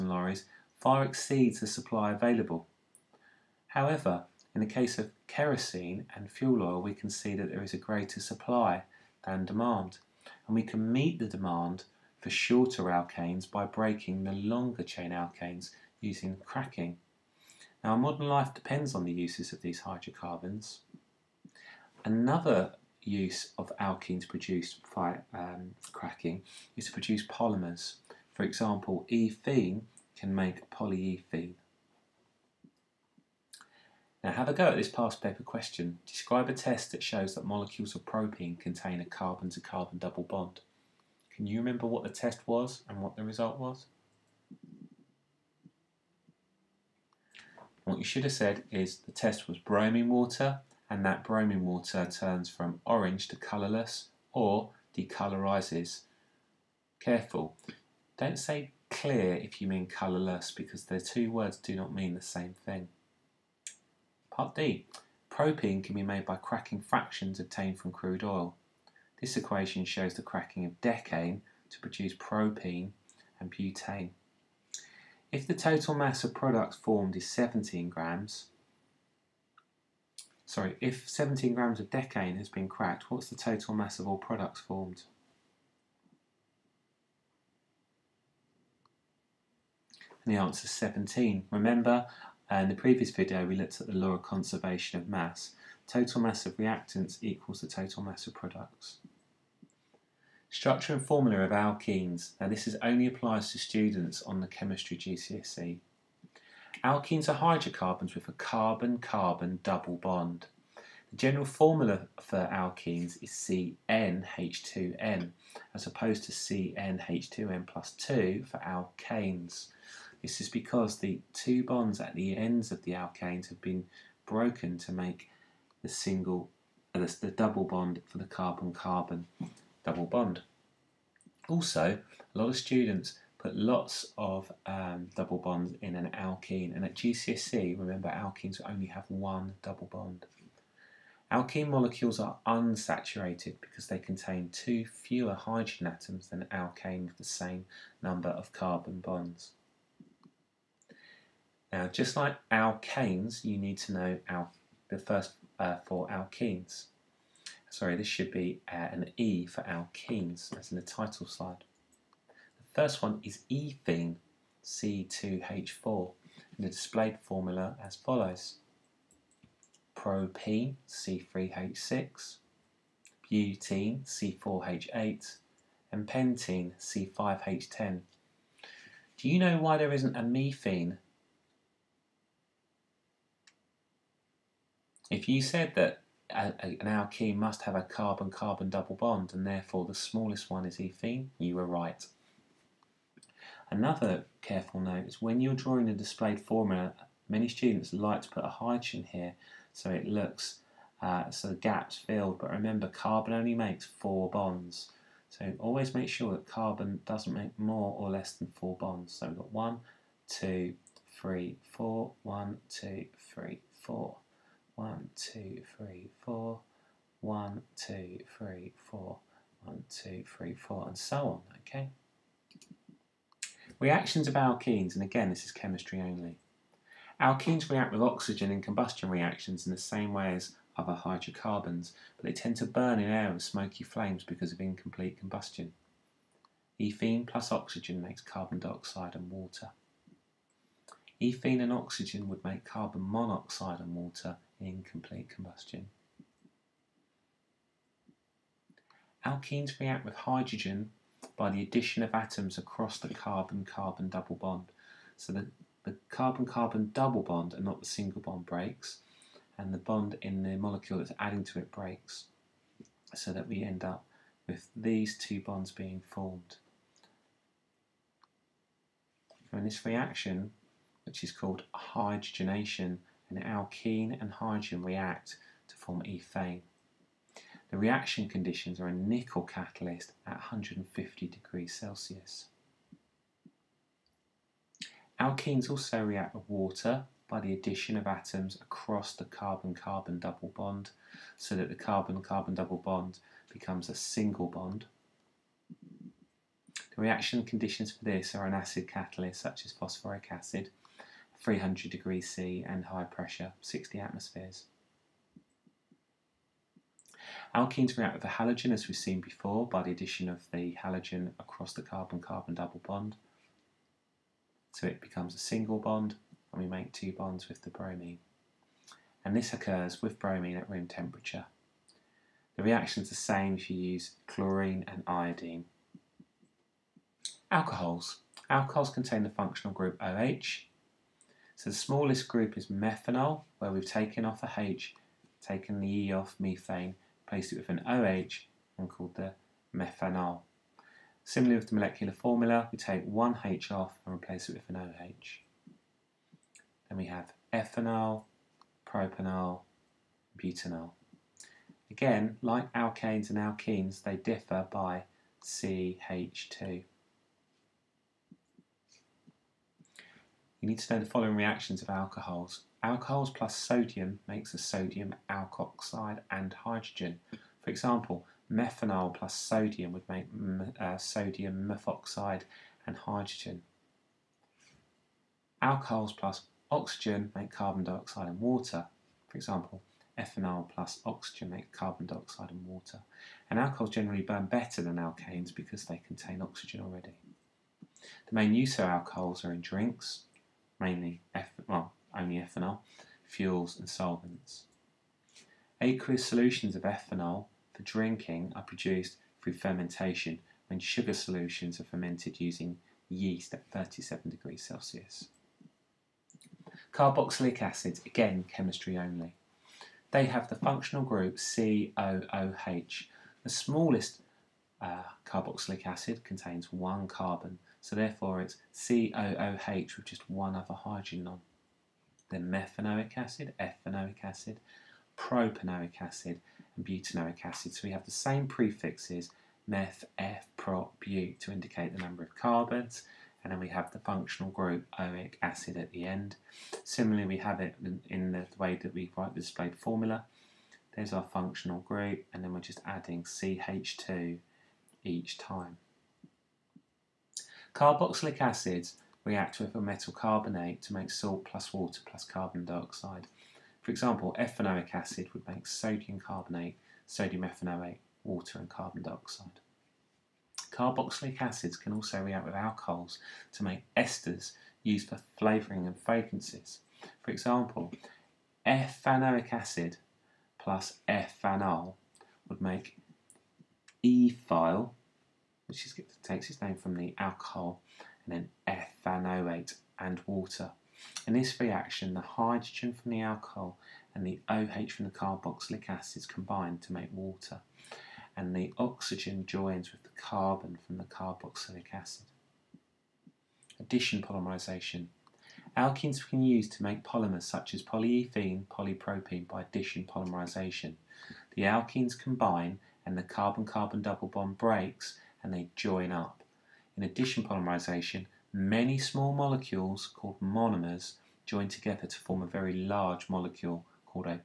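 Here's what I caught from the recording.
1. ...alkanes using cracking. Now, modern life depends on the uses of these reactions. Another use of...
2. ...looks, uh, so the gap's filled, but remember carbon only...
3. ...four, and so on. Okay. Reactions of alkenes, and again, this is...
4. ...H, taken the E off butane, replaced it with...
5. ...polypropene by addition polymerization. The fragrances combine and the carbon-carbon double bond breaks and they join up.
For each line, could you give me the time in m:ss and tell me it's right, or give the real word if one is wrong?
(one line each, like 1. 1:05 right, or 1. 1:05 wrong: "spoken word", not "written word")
1. 0:15 wrong: "hydrocarbons", not "reactions"
2. 3:20 right
3. 3:40 right
4. 5:34 wrong: "methane", not "butane"
5. 8:18 wrong: "alkenes", not "fragrances".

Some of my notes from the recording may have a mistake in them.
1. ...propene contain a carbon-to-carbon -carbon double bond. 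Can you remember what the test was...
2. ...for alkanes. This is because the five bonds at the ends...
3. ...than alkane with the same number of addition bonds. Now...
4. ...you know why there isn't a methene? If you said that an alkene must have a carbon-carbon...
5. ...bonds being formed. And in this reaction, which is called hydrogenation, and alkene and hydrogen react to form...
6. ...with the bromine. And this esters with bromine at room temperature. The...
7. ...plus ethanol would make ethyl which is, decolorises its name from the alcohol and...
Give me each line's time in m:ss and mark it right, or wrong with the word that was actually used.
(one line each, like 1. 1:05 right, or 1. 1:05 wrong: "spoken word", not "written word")
1. 0:38 right
2. 1:58 wrong: "two", not "five"
3. 2:26 wrong: "carbon", not "addition"
4. 2:59 right
5. 4:25 right
6. 5:17 wrong: "occurs", not "esters"
7. 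7:50 wrong: "takes", not "decolorises".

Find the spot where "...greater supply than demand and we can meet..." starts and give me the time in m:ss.
0:07.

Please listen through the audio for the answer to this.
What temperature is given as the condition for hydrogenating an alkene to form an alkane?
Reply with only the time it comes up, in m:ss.
4:40.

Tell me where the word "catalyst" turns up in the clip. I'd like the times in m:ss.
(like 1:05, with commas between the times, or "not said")
4:39, 4:58.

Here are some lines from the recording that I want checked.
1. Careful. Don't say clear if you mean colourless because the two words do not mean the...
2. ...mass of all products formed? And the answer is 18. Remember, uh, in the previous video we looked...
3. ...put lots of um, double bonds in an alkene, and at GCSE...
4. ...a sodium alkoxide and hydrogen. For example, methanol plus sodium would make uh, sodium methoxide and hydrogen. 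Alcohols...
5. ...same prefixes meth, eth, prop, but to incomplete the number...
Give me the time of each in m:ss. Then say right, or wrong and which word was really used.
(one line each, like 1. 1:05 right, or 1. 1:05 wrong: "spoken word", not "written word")
1. 0:57 right
2. 1:23 wrong: "17", not "18"
3. 2:13 right
4. 6:04 right
5. 7:08 wrong: "indicate", not "incomplete".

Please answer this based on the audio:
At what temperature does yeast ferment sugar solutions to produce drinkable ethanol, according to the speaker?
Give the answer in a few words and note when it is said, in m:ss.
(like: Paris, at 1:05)
37 degrees Celsius, at 6:43.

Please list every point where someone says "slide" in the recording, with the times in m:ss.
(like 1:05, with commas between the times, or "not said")
2:41.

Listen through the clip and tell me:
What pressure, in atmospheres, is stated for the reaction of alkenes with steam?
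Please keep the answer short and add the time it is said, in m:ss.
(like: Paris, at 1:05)
60 atmospheres, at 5:03.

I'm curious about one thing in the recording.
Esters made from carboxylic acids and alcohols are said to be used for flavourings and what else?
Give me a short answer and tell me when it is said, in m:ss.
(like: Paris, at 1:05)
Fragrances, at 7:45.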